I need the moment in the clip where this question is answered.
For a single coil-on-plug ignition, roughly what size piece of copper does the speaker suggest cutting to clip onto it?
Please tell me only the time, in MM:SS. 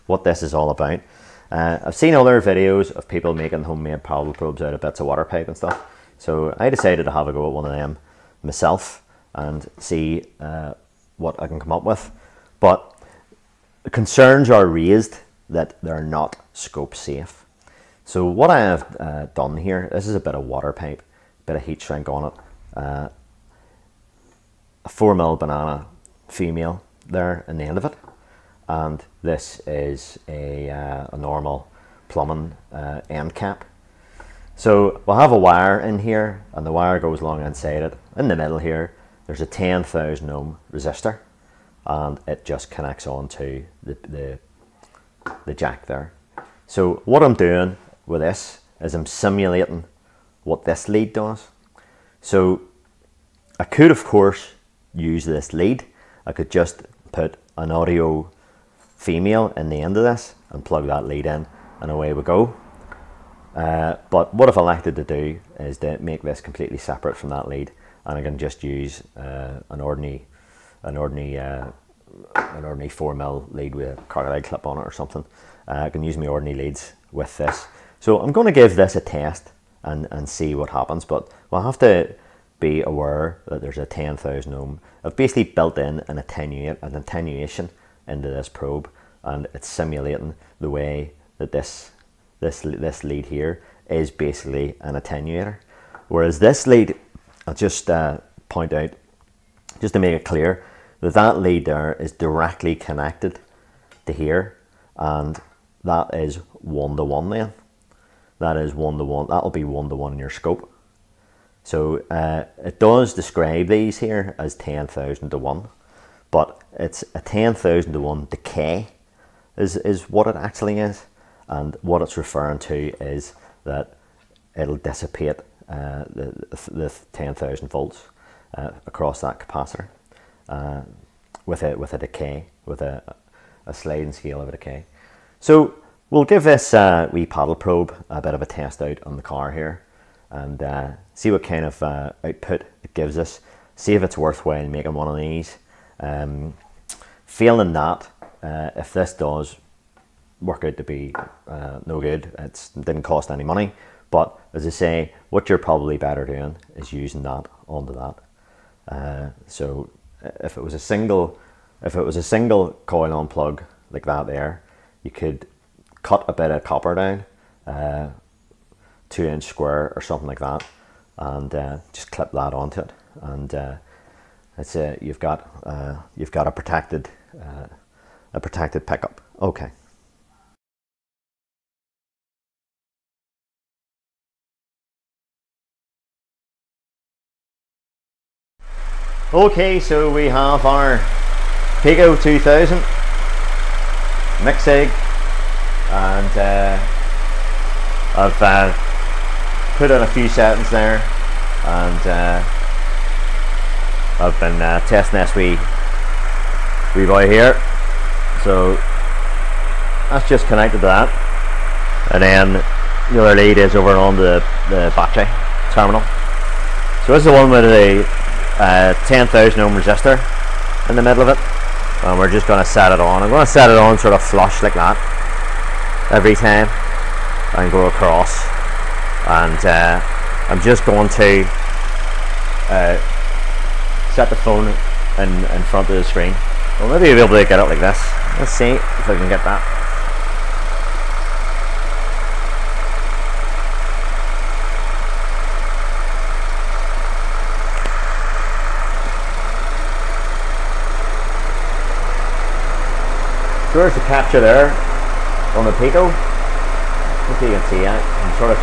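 02:49.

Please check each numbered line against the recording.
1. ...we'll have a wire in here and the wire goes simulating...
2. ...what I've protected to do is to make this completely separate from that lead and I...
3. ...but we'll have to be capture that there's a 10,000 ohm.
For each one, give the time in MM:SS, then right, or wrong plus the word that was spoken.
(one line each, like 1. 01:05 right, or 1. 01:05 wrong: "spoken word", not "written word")
1. 00:35 wrong: "along", not "simulating"
2. 01:04 wrong: "elected", not "protected"
3. 01:21 wrong: "aware", not "capture".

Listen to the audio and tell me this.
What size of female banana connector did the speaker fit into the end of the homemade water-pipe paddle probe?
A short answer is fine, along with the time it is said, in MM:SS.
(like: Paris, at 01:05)
4 mil, at 00:24.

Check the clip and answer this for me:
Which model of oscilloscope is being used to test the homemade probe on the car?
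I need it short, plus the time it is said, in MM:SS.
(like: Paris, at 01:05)
Pico 2000, at 03:11.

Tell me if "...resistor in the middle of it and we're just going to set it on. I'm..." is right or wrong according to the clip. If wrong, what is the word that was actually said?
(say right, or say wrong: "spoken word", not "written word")
right.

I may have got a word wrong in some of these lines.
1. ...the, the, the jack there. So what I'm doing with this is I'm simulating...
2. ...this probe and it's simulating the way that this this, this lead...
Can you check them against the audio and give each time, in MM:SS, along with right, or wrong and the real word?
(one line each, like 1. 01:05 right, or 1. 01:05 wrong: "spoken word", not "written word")
1. 00:43 right
2. 01:28 right.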